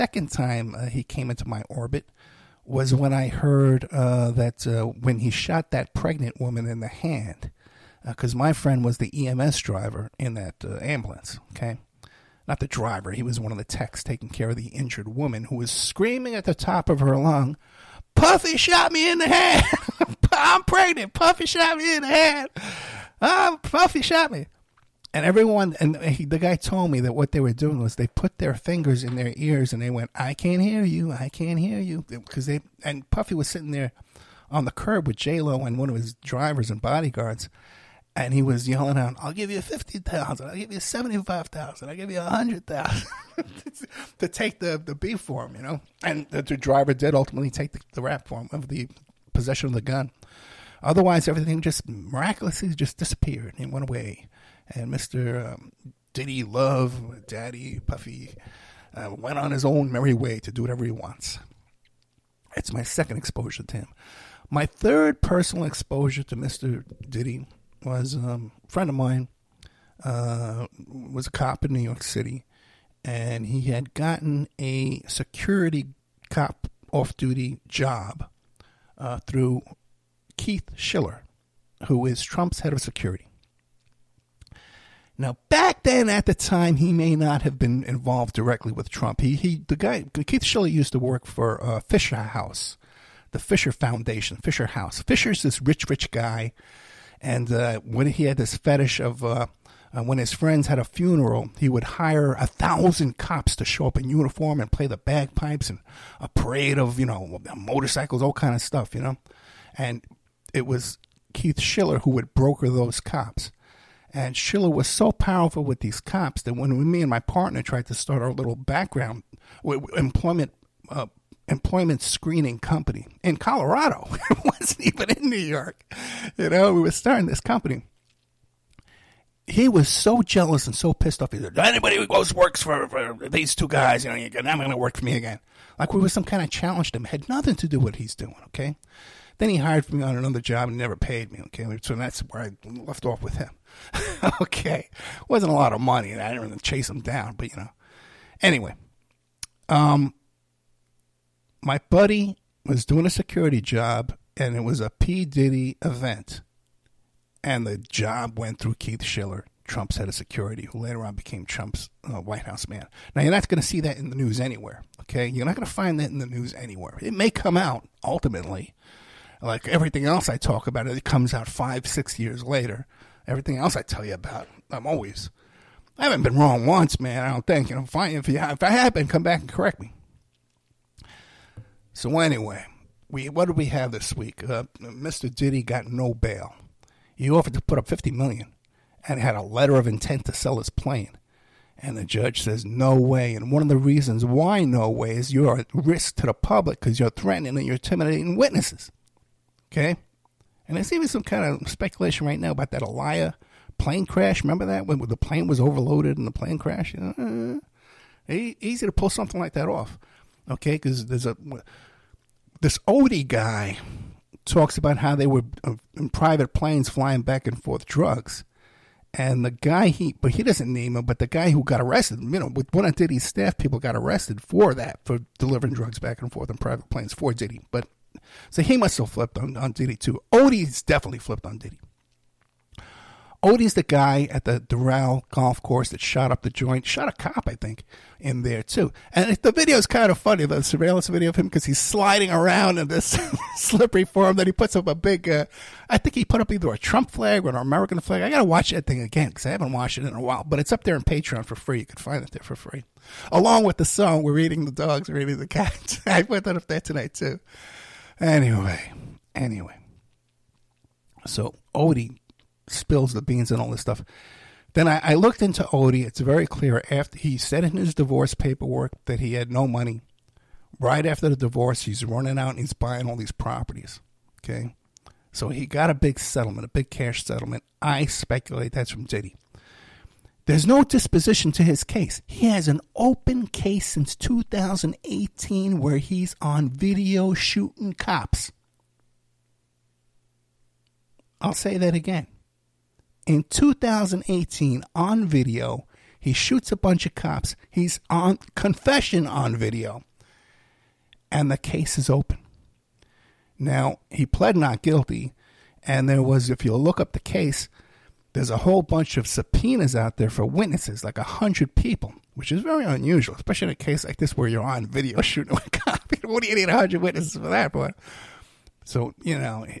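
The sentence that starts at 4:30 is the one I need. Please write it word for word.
Right after the divorce, he's running out and he's buying all these properties.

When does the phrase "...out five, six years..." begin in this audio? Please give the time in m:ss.
2:51.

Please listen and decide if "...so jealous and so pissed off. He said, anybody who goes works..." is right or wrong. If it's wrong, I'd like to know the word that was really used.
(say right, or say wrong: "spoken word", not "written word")
right.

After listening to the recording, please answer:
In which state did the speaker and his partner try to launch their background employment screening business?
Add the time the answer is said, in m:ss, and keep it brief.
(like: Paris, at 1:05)
Colorado, at 2:03.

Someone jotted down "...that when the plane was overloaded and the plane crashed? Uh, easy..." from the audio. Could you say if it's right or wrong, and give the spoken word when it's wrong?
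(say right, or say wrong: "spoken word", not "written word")
right.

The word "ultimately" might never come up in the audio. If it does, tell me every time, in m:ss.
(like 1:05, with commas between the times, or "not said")
0:47, 2:48.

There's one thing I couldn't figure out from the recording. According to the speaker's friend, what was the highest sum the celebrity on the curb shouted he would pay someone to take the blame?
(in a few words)
100,000.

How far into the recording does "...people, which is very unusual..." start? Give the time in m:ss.
5:11.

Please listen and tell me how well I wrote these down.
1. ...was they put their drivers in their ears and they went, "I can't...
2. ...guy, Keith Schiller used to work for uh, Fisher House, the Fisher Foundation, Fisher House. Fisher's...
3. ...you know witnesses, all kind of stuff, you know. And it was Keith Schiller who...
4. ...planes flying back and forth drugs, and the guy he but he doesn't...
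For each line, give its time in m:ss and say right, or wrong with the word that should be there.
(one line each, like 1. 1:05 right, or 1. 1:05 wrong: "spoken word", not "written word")
1. 0:27 wrong: "fingers", not "drivers"
2. 1:29 right
3. 1:46 wrong: "motorcycles", not "witnesses"
4. 3:36 right.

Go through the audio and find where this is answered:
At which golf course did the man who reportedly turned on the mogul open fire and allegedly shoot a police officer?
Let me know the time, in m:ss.
3:54.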